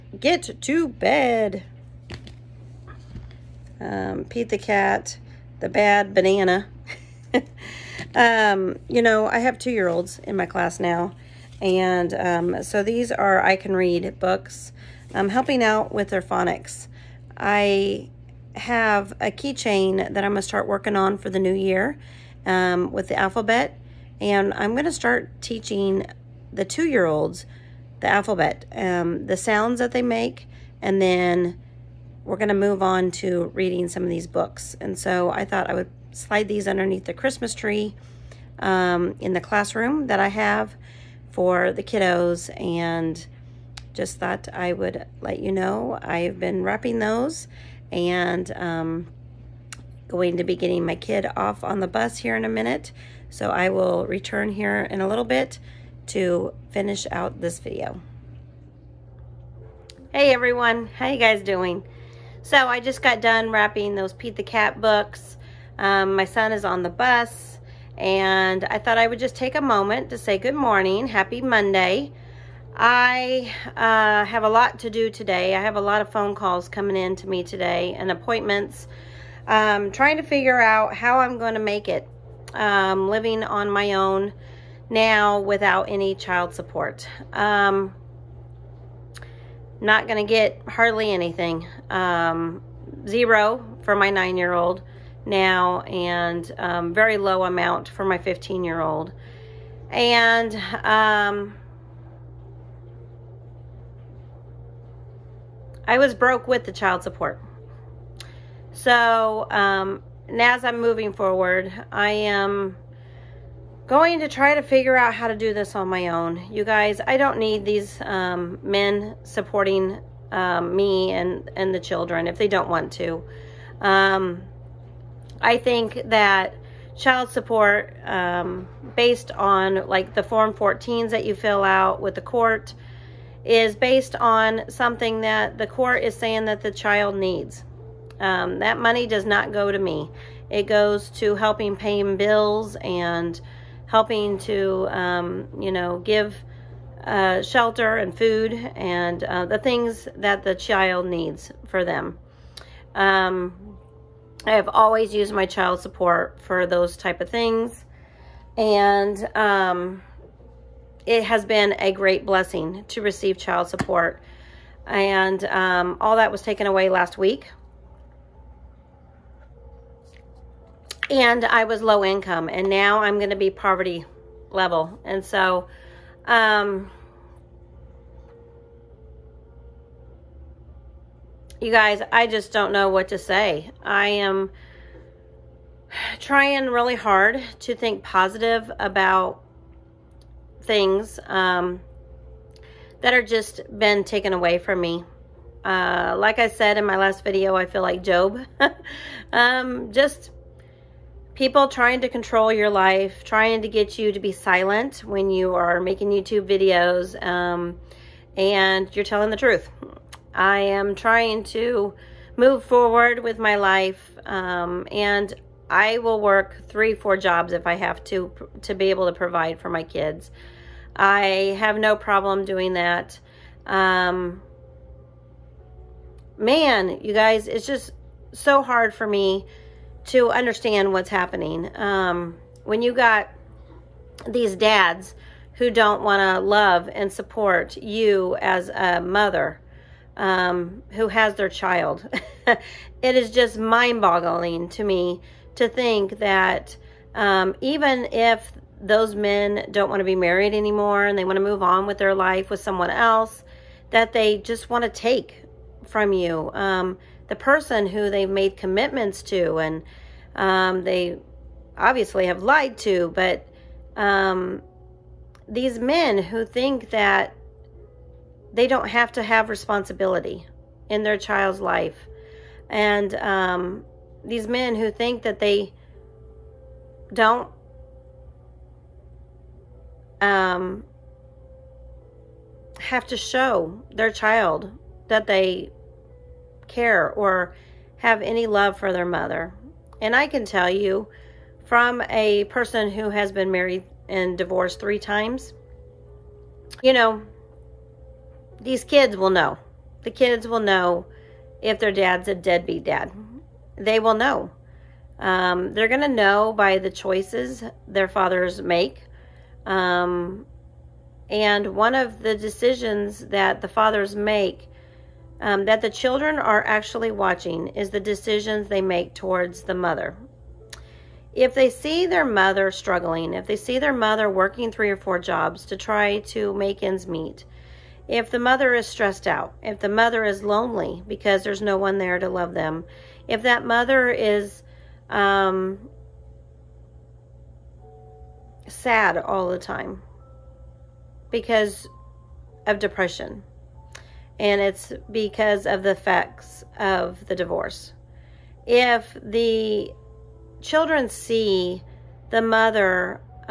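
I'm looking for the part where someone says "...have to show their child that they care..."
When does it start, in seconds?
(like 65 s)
282 s.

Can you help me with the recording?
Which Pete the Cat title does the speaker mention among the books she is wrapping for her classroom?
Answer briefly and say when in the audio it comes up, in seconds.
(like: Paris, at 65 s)
The Bad Banana, at 5 s.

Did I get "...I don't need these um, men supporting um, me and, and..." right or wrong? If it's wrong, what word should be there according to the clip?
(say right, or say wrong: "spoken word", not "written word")
right.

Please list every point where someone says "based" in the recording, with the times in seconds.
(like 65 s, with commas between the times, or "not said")
128 s, 133 s.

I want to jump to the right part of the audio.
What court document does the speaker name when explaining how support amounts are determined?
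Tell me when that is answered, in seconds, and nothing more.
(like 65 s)
130 s.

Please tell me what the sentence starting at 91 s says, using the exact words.
Um, zero for my nine-year-old now and um, very low amount for my 15 year old.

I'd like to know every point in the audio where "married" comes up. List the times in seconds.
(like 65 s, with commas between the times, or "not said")
250 s, 293 s.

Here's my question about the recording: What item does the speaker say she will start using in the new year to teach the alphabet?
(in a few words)
Keychain.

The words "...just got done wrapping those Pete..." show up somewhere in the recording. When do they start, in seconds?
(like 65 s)
62 s.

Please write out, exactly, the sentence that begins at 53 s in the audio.
So I will return here in a little bit to finish out this video.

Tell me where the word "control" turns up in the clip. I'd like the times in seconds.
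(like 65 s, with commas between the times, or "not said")
202 s.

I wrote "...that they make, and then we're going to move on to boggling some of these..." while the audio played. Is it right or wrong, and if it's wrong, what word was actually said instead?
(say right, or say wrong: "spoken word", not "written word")
wrong: "reading", not "boggling".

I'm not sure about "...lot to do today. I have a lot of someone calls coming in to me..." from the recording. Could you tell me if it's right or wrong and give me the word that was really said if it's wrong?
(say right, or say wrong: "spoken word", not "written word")
wrong: "phone", not "someone".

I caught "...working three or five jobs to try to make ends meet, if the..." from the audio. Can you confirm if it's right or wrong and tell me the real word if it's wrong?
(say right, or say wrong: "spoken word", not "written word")
wrong: "four", not "five".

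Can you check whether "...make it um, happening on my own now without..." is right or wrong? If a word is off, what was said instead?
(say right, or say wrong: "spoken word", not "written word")
wrong: "living", not "happening".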